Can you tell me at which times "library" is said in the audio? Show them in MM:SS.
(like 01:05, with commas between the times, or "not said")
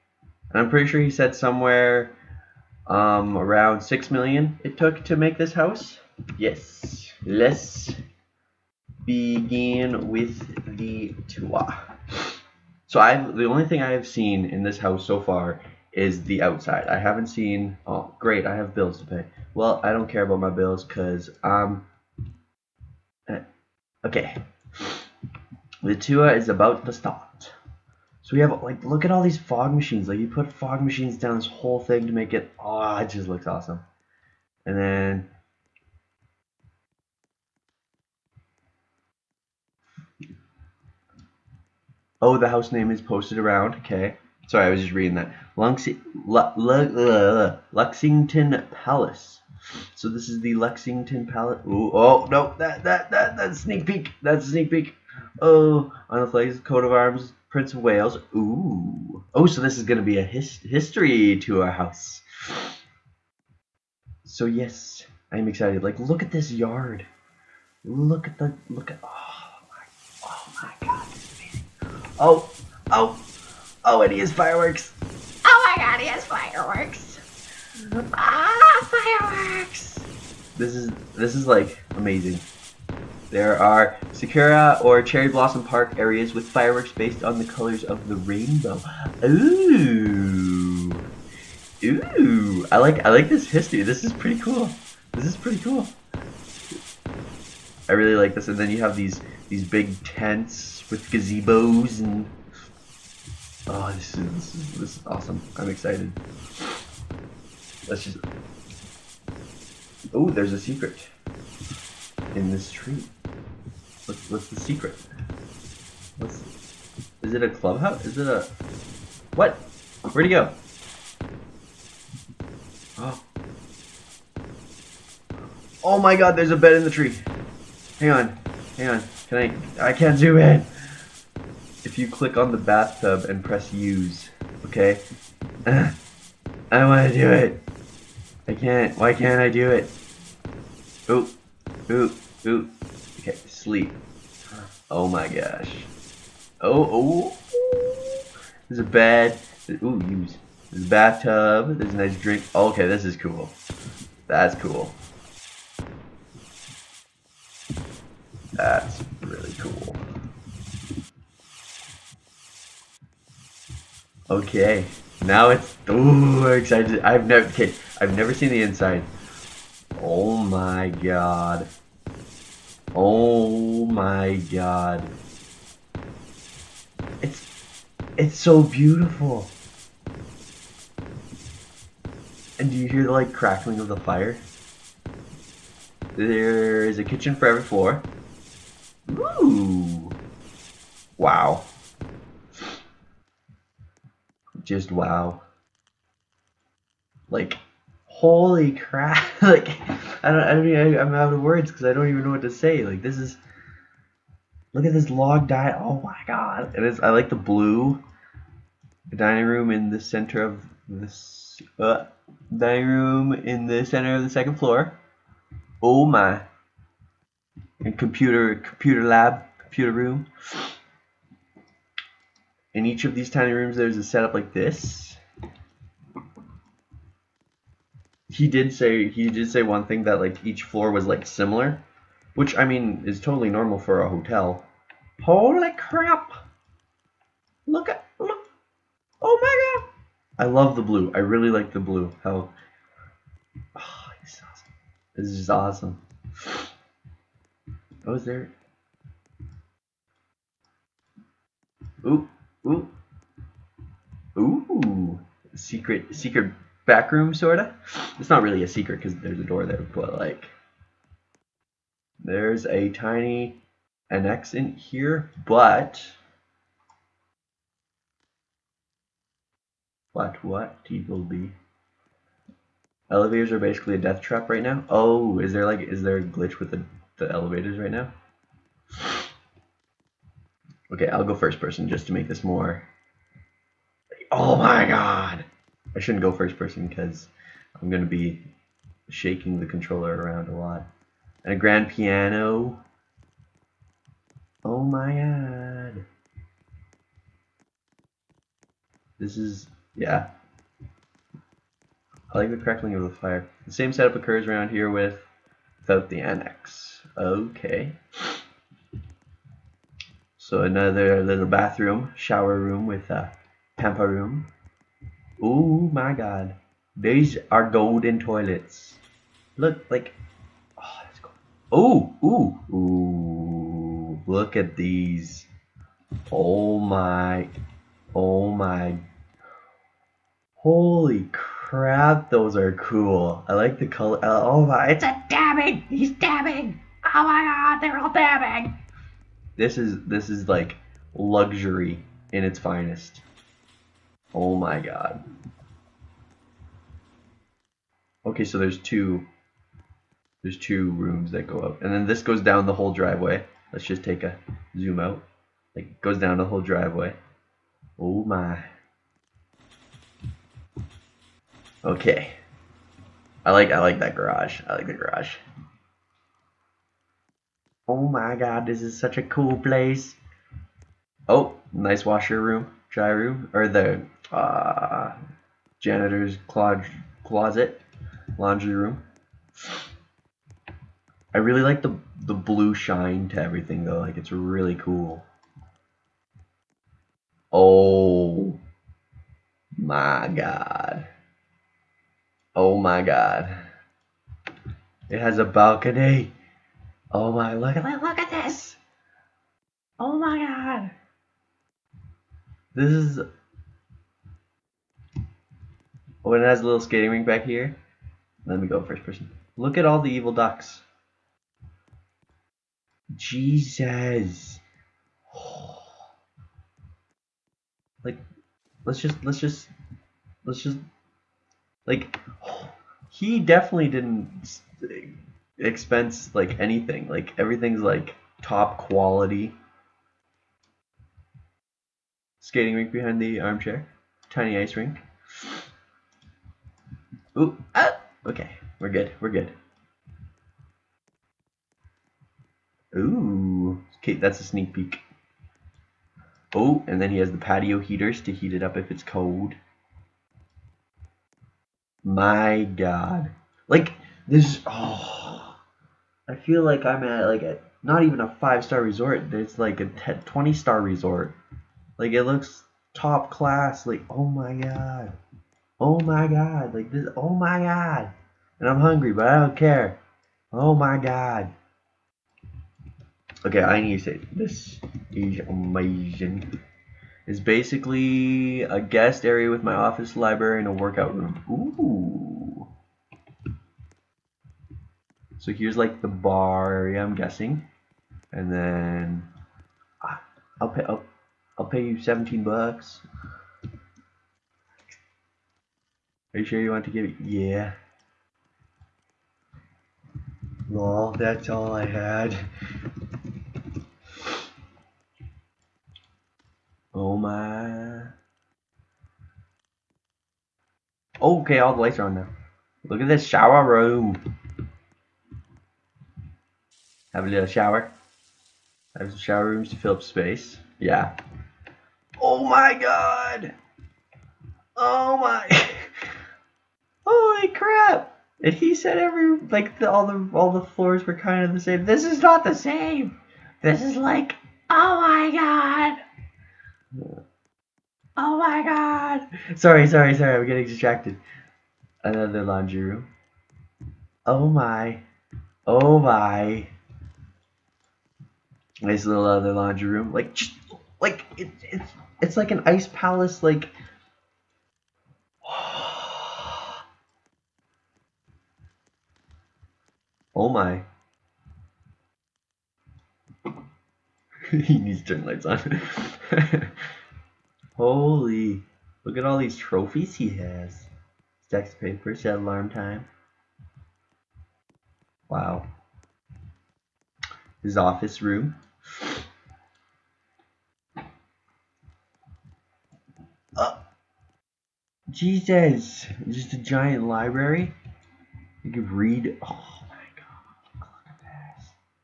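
08:00, 09:47.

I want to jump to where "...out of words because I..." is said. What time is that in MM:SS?
03:21.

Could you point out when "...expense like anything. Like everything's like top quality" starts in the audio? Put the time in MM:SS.
07:05.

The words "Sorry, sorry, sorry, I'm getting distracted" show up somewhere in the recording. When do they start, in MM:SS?
08:59.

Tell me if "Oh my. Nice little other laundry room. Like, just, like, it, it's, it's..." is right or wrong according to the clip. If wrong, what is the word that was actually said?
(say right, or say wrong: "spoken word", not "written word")
right.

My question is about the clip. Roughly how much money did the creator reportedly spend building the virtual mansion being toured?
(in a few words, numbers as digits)
6 million.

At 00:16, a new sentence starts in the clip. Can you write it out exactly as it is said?
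I haven't seen, oh, great, I have bills to pay.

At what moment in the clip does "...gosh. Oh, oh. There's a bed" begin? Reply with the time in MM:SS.
02:25.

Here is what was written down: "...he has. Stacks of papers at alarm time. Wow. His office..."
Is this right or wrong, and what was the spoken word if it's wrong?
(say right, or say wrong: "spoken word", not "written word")
right.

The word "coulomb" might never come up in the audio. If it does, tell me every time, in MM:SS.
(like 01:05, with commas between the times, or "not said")
not said.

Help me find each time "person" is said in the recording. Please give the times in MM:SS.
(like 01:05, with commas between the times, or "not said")
04:41, 04:46, 06:49.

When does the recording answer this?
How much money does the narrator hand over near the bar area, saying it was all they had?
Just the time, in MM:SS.
08:12.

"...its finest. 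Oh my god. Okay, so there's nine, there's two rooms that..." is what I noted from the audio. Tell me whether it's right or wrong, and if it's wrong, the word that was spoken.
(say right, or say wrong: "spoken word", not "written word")
wrong: "two", not "nine".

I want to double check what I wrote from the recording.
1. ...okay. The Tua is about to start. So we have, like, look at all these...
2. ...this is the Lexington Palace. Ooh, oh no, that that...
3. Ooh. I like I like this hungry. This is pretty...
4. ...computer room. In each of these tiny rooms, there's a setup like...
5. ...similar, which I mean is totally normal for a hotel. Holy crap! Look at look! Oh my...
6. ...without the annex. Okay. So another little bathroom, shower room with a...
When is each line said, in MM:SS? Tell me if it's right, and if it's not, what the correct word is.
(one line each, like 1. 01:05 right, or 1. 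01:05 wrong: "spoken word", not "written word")
1. 00:24 right
2. 00:50 right
3. 01:31 wrong: "history", not "hungry"
4. 03:39 right
5. 03:51 right
6. 05:05 right.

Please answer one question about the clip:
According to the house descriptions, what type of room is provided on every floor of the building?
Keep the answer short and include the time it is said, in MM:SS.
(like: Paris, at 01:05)
kitchen, at 03:07.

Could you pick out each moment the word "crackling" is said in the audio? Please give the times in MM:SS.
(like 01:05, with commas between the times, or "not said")
03:03, 05:02.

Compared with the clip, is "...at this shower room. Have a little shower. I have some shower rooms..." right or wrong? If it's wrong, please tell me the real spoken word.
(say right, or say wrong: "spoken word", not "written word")
right.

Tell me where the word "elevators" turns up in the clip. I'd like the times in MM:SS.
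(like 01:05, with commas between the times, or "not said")
04:33, 04:37.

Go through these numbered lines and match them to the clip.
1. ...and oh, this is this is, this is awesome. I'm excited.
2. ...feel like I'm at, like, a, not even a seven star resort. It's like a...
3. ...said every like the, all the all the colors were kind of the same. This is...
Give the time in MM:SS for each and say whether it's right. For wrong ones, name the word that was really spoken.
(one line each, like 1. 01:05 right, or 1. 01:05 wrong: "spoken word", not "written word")
1. 01:42 right
2. 07:36 wrong: "five", not "seven"
3. 08:48 wrong: "floors", not "colors".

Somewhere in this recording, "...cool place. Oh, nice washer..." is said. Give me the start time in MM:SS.
06:09.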